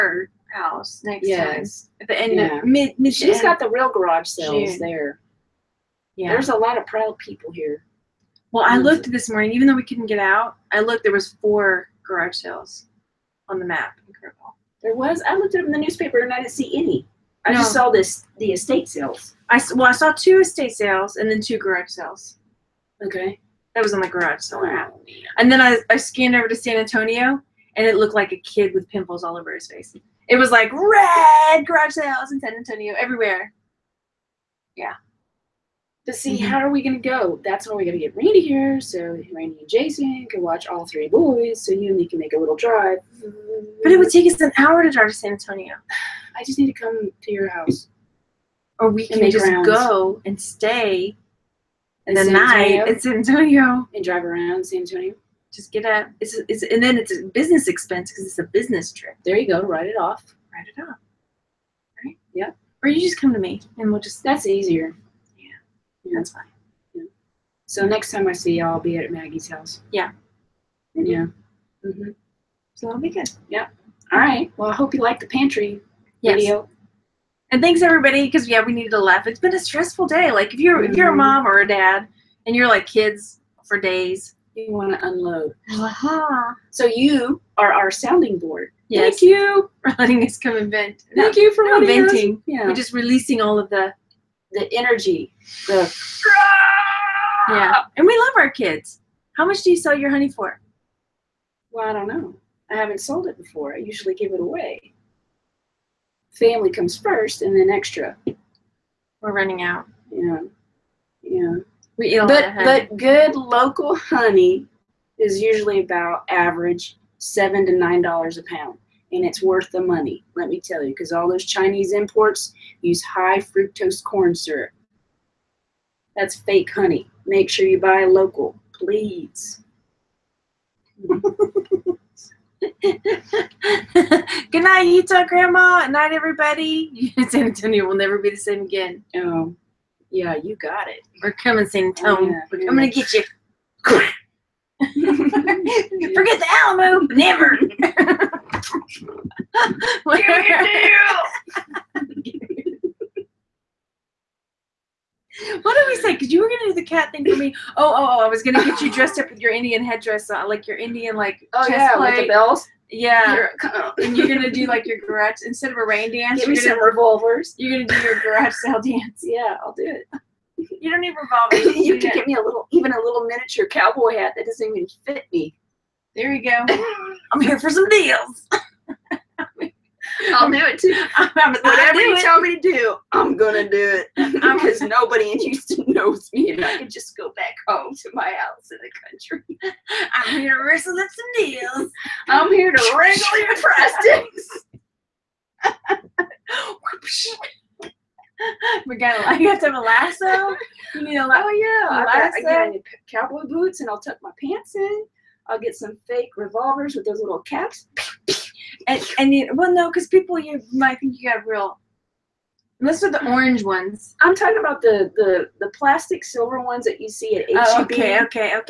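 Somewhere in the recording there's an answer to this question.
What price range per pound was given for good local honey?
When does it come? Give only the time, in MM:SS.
01:57.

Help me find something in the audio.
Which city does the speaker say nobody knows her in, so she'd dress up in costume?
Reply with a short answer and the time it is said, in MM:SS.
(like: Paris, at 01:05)
Houston, at 03:05.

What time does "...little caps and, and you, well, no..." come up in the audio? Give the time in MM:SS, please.
03:27.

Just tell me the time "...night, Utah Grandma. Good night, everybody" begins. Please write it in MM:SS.
02:14.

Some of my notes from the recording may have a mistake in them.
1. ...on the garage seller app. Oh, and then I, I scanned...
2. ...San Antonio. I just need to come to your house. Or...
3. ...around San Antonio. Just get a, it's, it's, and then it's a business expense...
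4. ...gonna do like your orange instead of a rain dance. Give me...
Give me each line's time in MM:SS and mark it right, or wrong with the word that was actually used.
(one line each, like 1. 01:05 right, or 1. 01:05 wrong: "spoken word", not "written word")
1. 00:23 right
2. 00:45 right
3. 00:54 right
4. 02:44 wrong: "garage", not "orange".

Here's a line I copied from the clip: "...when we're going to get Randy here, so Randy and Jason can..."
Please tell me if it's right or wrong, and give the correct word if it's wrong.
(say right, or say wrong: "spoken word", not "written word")
right.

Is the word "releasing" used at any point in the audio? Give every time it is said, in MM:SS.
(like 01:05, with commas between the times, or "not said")
01:32.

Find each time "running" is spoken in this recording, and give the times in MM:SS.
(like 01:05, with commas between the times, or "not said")
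01:49.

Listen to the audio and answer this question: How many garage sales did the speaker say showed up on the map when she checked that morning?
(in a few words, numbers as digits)
4.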